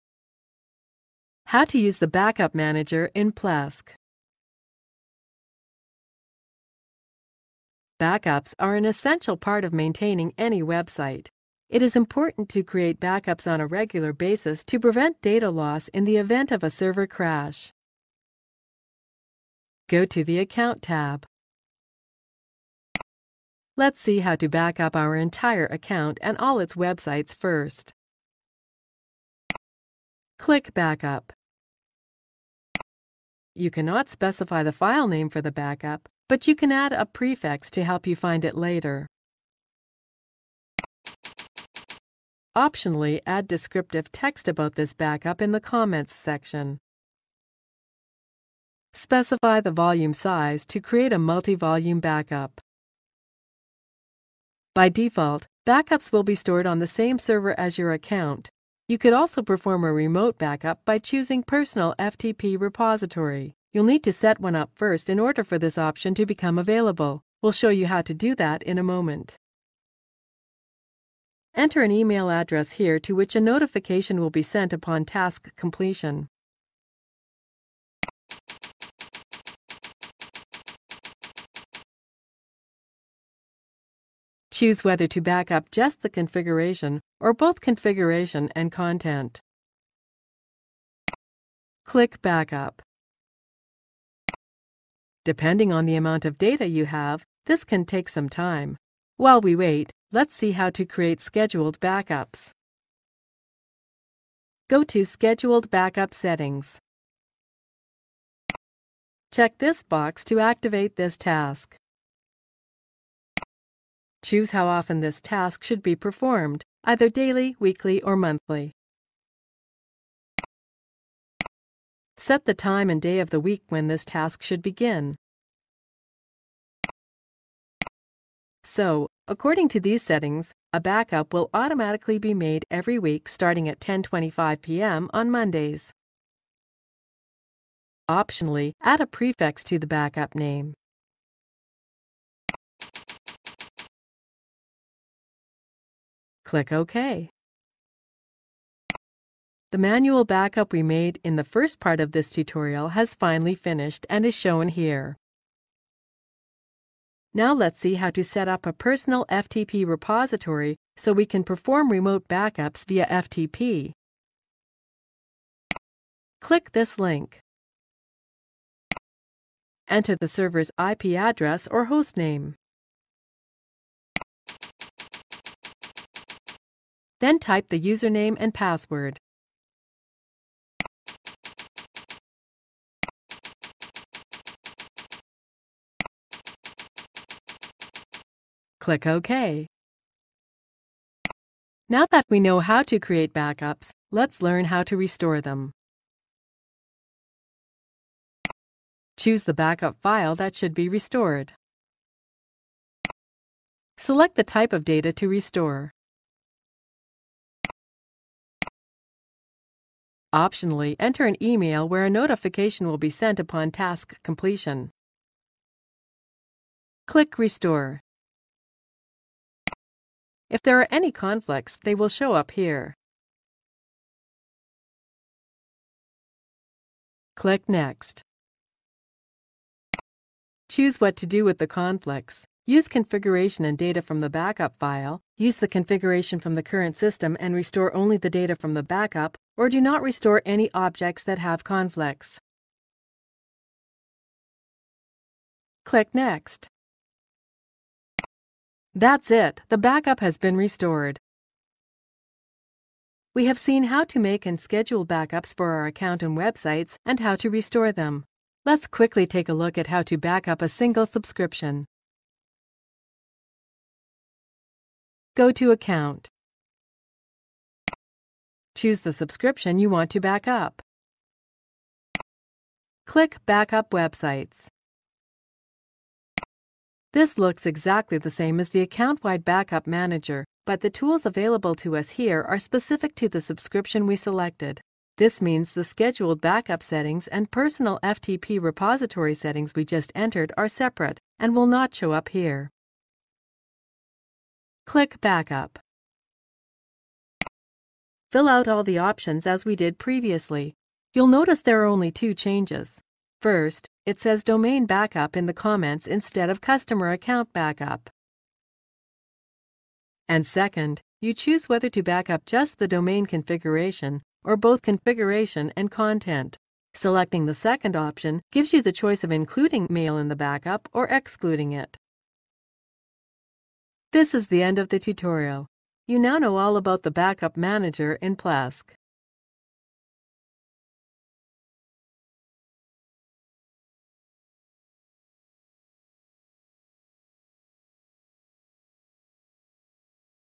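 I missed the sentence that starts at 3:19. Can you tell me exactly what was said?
Choose the backup file that should be restored.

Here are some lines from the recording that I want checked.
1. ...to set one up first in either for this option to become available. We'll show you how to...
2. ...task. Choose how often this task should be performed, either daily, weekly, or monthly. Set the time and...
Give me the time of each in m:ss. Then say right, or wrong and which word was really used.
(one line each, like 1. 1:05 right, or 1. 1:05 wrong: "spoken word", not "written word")
1. 1:04 wrong: "order", not "either"
2. 1:51 right.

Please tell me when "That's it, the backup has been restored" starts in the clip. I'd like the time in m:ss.
4:08.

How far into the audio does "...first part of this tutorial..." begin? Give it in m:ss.
2:31.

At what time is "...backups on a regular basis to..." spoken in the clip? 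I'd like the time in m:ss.
0:13.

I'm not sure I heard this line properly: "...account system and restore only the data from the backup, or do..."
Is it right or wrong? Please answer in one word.
wrong.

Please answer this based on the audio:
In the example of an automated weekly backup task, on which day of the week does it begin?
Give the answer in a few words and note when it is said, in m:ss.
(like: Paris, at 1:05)
Mondays, at 2:15.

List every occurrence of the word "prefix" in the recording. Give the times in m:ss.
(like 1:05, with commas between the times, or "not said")
0:37, 2:19.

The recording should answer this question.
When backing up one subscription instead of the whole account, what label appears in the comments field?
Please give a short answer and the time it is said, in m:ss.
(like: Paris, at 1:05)
Domain Backup, at 5:04.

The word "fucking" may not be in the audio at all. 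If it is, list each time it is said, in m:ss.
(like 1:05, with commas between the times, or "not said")
not said.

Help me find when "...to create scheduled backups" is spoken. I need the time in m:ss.
1:40.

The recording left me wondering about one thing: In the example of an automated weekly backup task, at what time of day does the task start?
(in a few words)
10:25 p.m.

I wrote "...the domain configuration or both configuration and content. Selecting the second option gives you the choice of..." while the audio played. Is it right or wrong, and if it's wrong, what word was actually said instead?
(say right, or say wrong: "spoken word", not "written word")
right.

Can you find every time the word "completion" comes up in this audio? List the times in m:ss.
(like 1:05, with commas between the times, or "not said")
1:15, 3:34.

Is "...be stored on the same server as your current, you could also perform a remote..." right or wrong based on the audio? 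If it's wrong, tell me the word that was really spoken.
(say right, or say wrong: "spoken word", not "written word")
wrong: "account", not "current".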